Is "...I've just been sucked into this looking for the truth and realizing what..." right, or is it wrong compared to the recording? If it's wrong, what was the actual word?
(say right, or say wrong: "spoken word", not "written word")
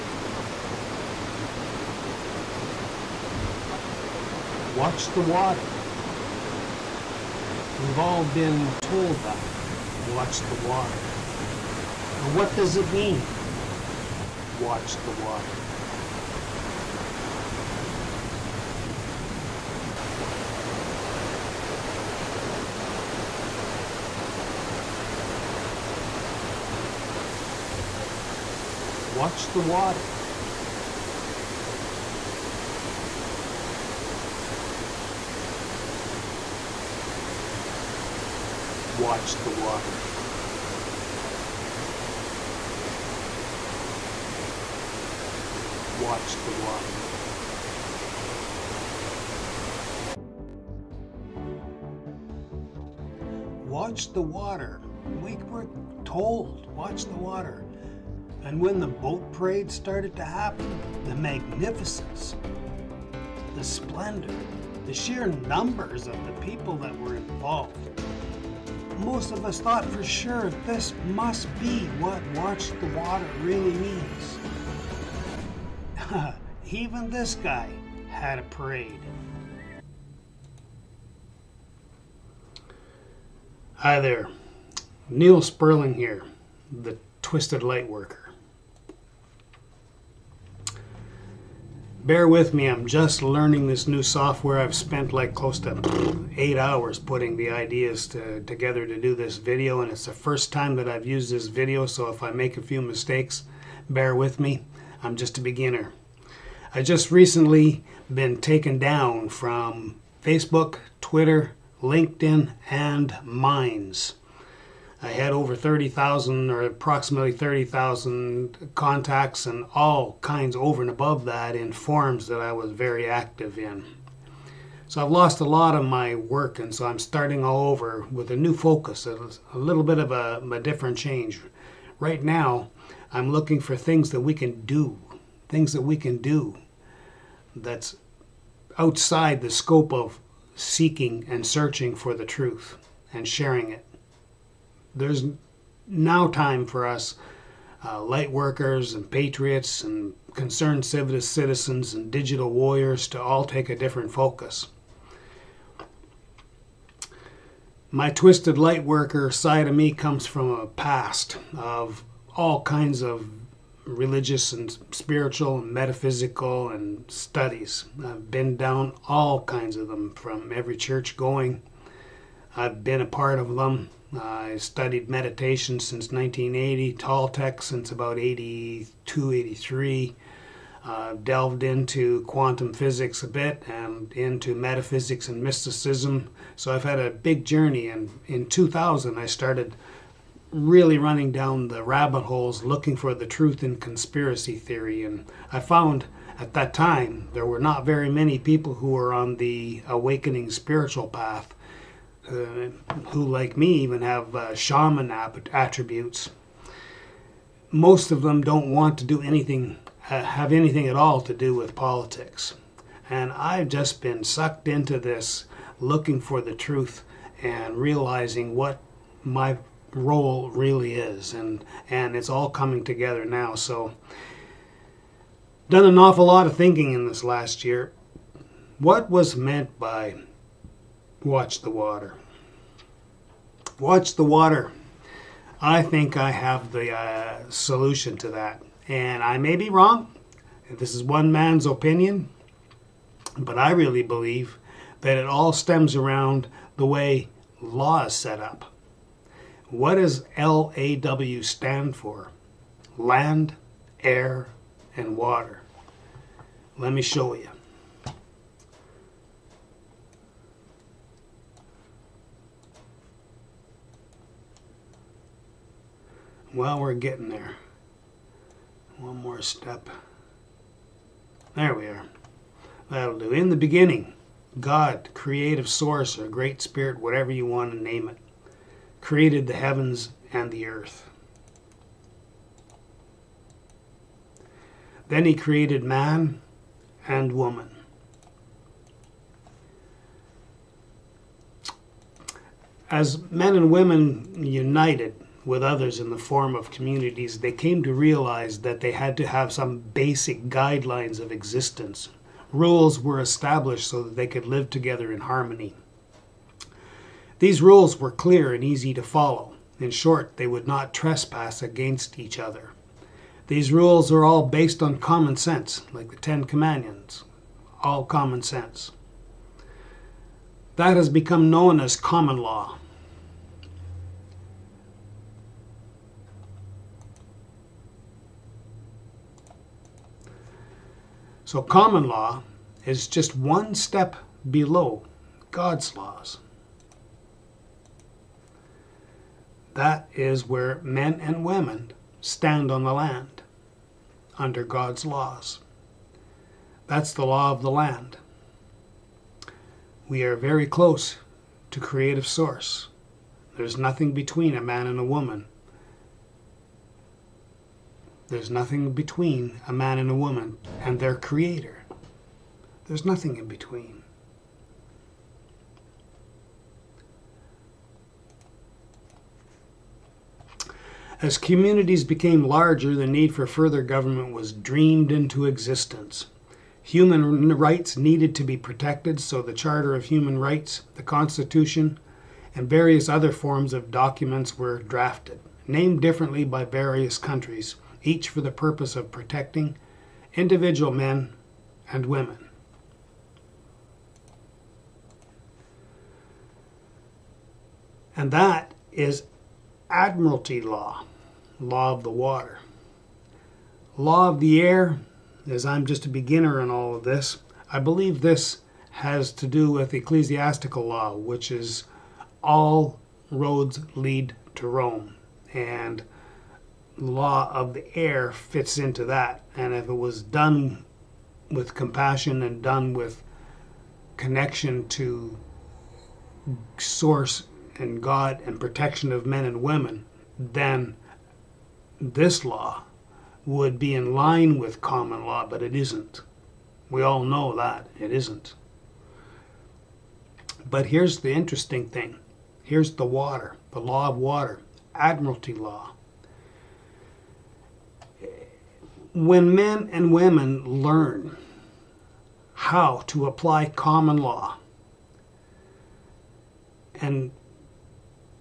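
right.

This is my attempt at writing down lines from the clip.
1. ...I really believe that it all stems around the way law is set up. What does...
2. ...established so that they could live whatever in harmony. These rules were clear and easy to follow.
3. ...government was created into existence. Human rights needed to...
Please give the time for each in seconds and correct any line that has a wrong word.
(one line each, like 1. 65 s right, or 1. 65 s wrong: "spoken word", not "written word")
1. 243 s right
2. 303 s wrong: "together", not "whatever"
3. 373 s wrong: "dreamed", not "created".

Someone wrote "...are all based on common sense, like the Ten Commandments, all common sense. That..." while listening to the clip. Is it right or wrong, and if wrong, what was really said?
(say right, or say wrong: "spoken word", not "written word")
right.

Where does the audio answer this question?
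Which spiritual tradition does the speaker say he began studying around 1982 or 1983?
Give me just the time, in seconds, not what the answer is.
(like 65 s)
176 s.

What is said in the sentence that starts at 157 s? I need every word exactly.
My twisted light worker side of me comes from a past of all kinds of religious and spiritual and metaphysical and studies.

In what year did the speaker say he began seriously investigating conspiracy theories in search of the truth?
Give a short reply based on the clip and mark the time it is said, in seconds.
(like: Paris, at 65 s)
2000, at 188 s.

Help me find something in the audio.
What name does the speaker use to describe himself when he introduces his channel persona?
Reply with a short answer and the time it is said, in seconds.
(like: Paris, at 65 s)
The Twisted Light Worker, at 86 s.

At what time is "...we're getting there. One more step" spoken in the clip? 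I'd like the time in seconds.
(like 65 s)
266 s.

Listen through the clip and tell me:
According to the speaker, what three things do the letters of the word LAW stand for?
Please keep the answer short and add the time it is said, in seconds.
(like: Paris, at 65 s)
Land, air, and water, at 252 s.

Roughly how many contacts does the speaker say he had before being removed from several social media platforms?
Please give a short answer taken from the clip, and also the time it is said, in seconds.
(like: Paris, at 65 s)
30,000, at 116 s.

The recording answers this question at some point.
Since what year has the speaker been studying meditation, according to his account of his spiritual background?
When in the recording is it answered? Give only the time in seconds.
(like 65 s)
176 s.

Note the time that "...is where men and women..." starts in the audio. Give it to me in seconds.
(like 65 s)
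340 s.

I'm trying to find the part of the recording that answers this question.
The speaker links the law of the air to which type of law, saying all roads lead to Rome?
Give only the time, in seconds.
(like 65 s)
409 s.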